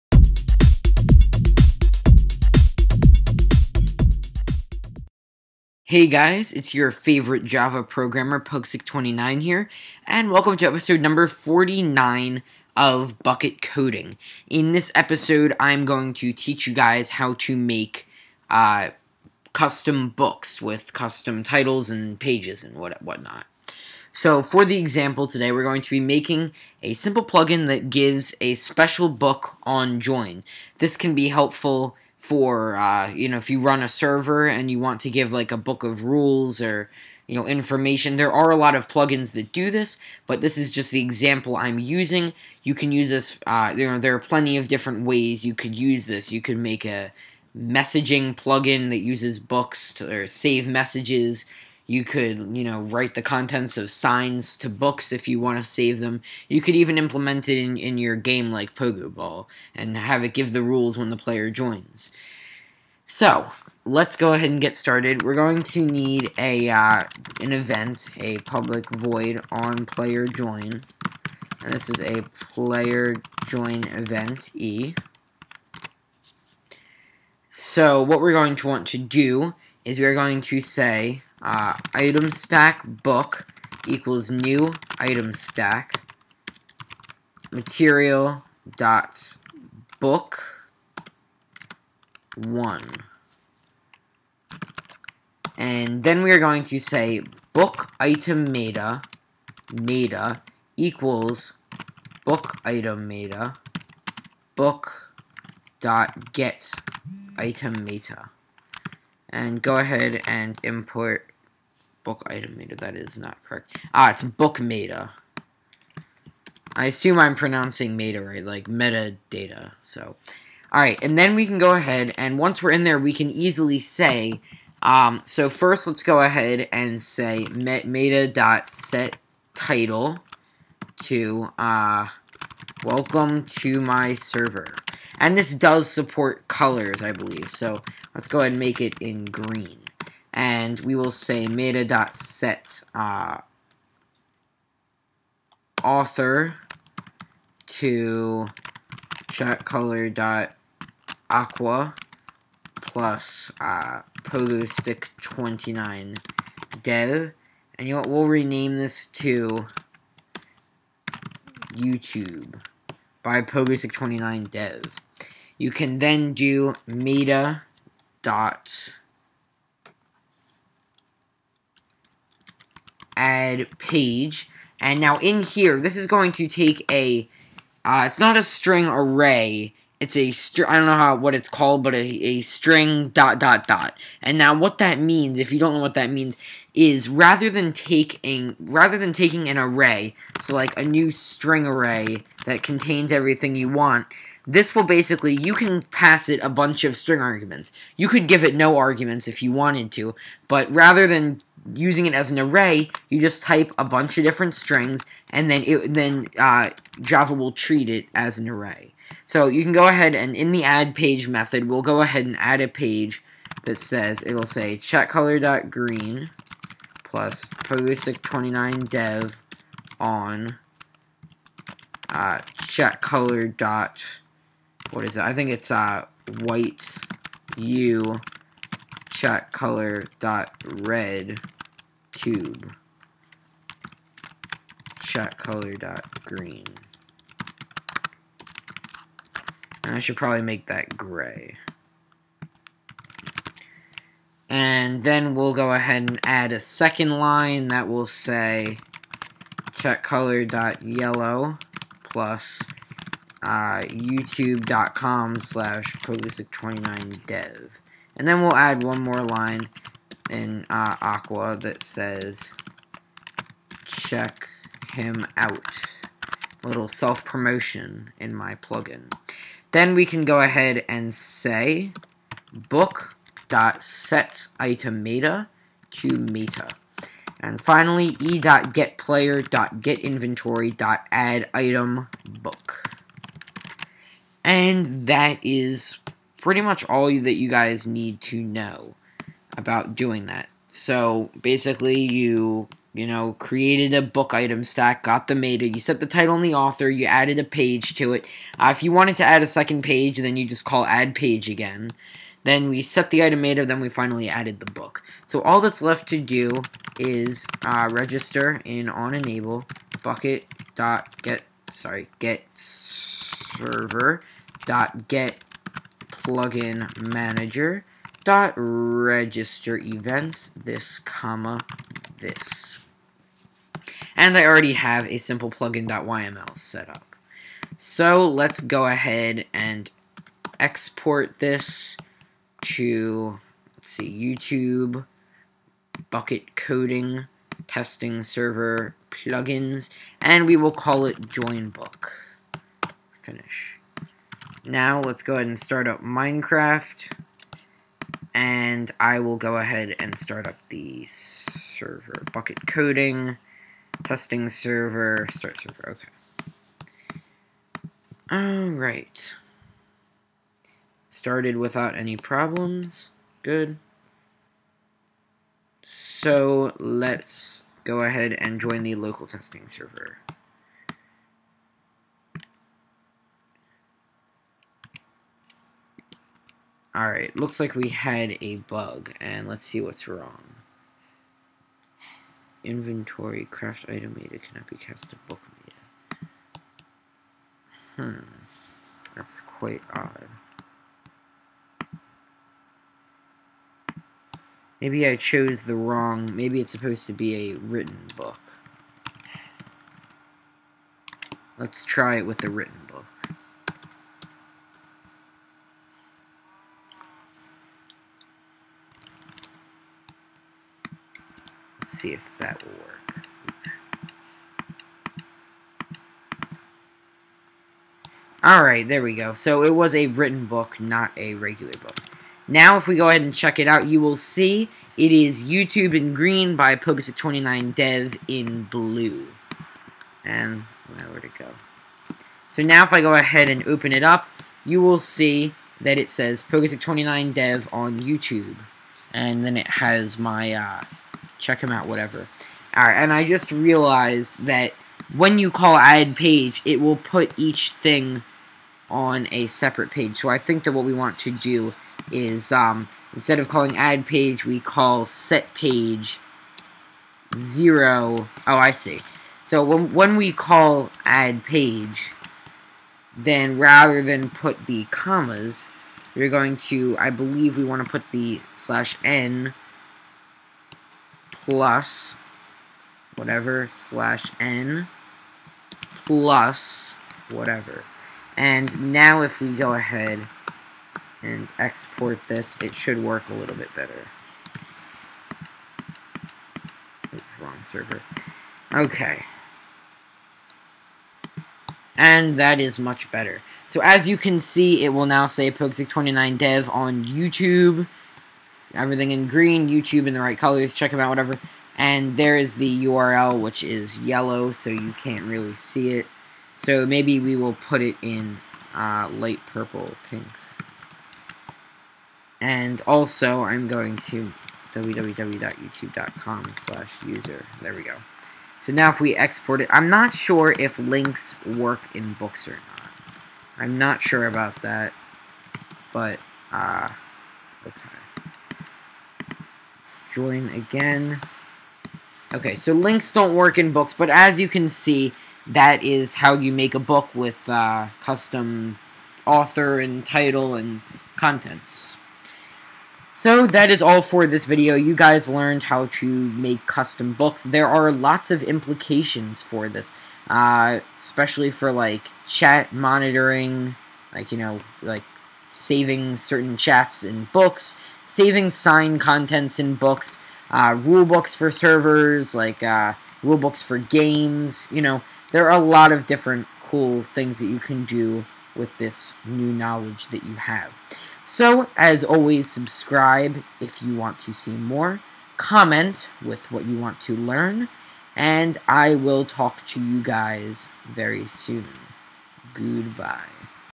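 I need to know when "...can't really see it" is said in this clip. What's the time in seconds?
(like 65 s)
505 s.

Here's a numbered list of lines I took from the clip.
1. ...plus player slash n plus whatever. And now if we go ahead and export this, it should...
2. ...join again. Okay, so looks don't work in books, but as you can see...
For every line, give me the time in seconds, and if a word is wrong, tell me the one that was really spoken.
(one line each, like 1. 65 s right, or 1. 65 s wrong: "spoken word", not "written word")
1. 471 s wrong: "whatever", not "player"
2. 530 s wrong: "links", not "looks".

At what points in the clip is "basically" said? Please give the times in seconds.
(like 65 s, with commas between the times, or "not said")
194 s, 291 s.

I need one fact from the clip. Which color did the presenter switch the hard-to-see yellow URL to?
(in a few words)
Light purple.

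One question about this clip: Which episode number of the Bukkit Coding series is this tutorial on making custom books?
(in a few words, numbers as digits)
49.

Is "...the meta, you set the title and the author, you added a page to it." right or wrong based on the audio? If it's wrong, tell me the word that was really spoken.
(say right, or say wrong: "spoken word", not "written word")
right.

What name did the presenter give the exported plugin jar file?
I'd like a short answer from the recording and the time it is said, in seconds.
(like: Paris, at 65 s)
Join Book, at 341 s.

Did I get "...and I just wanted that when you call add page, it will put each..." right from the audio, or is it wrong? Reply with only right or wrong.
wrong.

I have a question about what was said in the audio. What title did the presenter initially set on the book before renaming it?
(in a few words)
Welcome to my server.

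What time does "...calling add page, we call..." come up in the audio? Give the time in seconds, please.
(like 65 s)
453 s.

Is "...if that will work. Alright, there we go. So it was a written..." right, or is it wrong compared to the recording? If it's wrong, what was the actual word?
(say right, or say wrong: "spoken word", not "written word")
right.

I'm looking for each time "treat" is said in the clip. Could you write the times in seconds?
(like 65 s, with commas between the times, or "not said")
207 s.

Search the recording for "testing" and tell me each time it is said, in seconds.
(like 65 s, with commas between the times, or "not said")
337 s, 354 s, 369 s.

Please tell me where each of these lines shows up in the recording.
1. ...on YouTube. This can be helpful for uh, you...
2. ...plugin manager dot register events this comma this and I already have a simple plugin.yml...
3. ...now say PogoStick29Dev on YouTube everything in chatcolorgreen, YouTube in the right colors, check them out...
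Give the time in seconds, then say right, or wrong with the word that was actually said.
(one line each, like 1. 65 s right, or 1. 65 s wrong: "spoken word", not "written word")
1. 29 s wrong: "Join", not "YouTube"
2. 316 s right
3. 495 s wrong: "green", not "chatcolorgreen".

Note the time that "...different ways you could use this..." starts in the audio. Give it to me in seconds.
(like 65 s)
44 s.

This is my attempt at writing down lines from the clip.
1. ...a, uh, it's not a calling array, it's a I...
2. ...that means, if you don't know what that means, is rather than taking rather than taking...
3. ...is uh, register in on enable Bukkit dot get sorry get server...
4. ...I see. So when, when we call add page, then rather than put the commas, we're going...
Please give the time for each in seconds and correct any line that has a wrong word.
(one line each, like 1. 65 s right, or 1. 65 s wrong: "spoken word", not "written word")
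1. 176 s wrong: "string", not "calling"
2. 184 s right
3. 306 s right
4. 458 s right.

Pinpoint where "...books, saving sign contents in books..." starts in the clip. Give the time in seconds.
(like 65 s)
557 s.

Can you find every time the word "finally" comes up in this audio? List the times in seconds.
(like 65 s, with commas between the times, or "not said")
277 s, 303 s.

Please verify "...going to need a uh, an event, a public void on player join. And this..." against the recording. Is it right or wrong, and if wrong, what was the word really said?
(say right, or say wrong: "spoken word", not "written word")
right.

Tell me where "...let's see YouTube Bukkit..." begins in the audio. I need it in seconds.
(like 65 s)
333 s.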